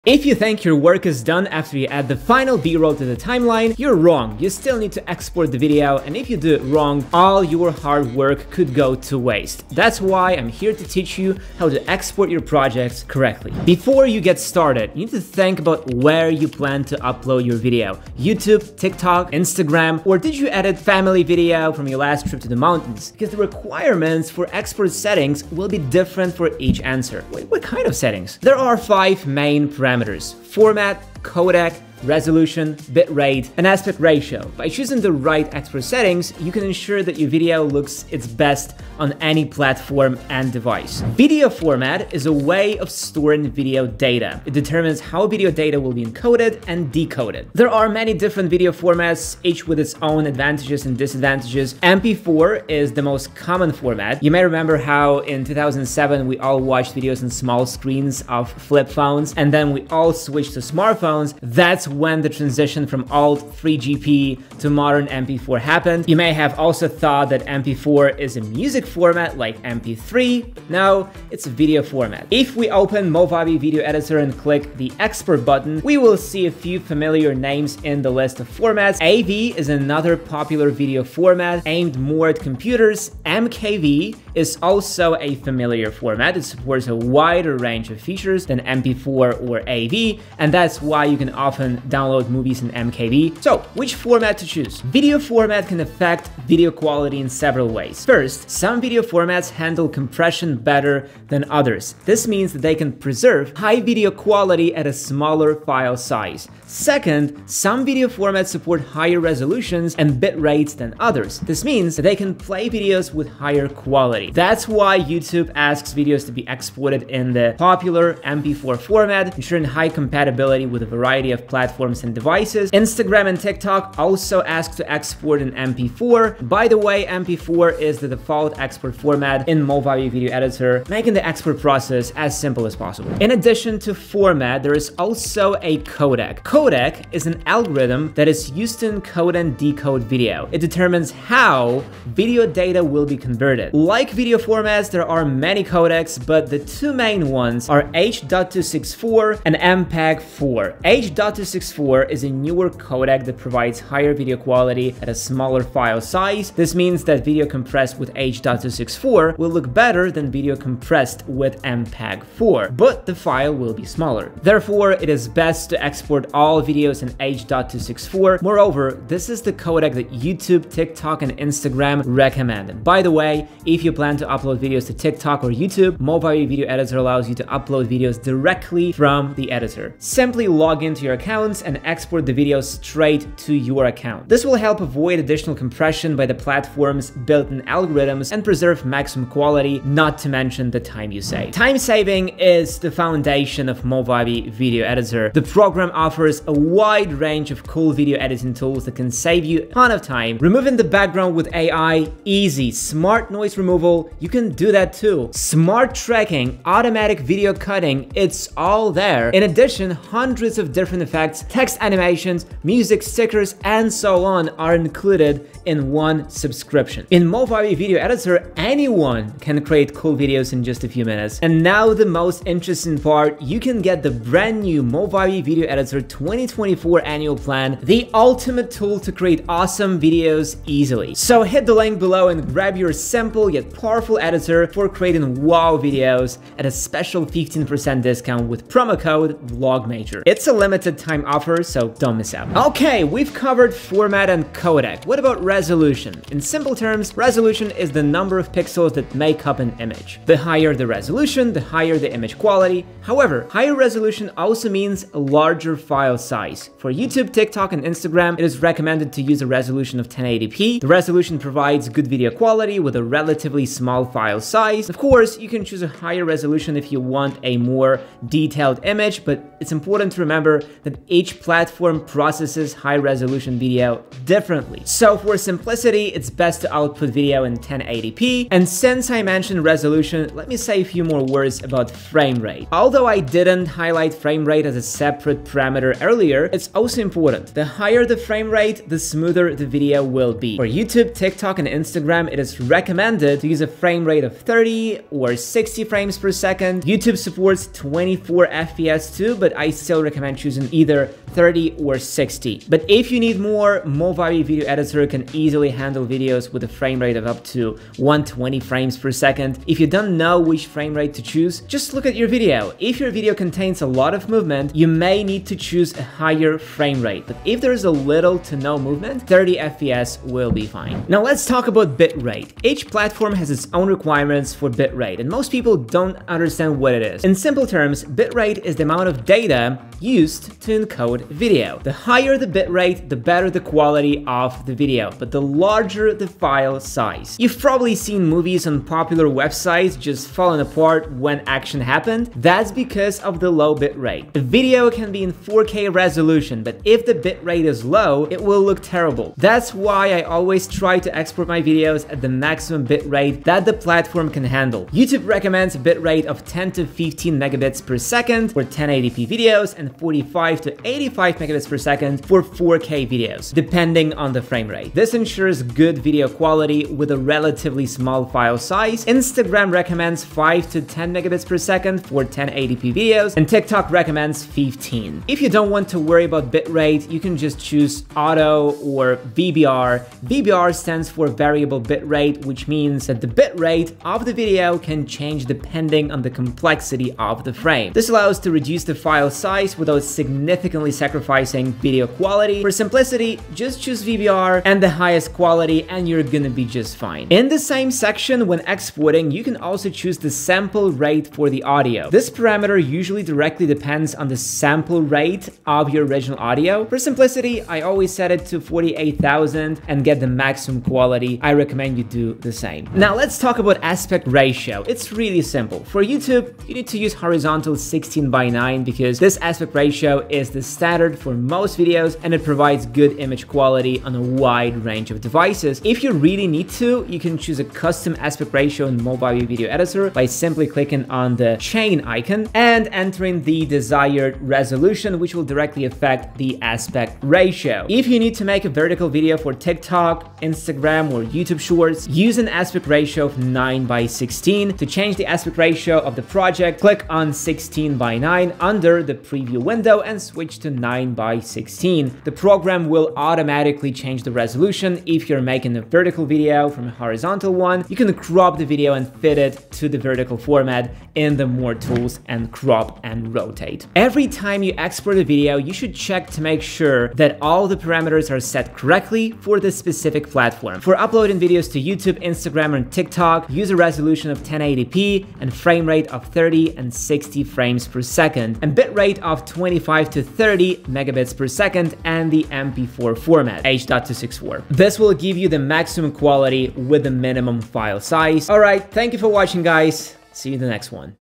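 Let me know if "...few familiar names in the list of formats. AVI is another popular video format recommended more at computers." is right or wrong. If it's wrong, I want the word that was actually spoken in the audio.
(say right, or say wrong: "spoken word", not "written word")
wrong: "aimed", not "recommended".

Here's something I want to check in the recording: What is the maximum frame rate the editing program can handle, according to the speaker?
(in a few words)
120 frames per second.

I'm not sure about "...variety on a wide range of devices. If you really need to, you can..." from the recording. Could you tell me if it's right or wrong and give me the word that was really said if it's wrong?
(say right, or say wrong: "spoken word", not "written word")
wrong: "quality", not "variety".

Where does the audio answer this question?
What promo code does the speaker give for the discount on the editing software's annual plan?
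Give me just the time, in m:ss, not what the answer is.
3:59.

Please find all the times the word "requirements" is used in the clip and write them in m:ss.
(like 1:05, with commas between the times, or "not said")
0:23, 5:23.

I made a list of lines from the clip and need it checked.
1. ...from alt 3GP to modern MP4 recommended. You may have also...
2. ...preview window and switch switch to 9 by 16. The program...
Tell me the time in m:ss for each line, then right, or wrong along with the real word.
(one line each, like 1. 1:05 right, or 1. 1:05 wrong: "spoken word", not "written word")
1. 1:02 wrong: "happened", not "recommended"
2. 7:29 right.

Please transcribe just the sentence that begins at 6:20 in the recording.
VBR stands for variable bitrate, which means that the bitrate of the video can change depending on the complexity of the frame.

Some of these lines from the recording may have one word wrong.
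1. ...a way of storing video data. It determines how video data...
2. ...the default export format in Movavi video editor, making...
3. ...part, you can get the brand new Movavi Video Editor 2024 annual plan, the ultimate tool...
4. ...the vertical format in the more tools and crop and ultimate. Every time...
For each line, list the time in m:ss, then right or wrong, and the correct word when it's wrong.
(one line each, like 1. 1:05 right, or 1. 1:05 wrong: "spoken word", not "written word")
1. 0:42 right
2. 2:07 right
3. 3:42 right
4. 7:39 wrong: "rotate", not "ultimate".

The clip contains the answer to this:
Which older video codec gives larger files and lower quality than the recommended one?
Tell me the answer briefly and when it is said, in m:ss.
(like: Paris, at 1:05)
MPEG-4, at 2:29.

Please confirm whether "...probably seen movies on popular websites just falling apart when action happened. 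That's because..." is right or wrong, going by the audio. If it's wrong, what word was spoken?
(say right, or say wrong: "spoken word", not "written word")
right.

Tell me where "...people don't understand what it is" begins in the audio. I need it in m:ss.
5:25.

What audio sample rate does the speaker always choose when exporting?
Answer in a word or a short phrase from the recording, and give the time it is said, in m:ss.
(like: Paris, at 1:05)
48,000, at 6:48.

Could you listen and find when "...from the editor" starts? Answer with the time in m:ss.
2:58.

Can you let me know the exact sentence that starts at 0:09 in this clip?
That's why I'm here to teach you how to export your projects correctly.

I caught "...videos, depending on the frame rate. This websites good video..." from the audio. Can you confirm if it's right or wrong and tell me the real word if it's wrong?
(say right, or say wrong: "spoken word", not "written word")
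wrong: "ensures", not "websites".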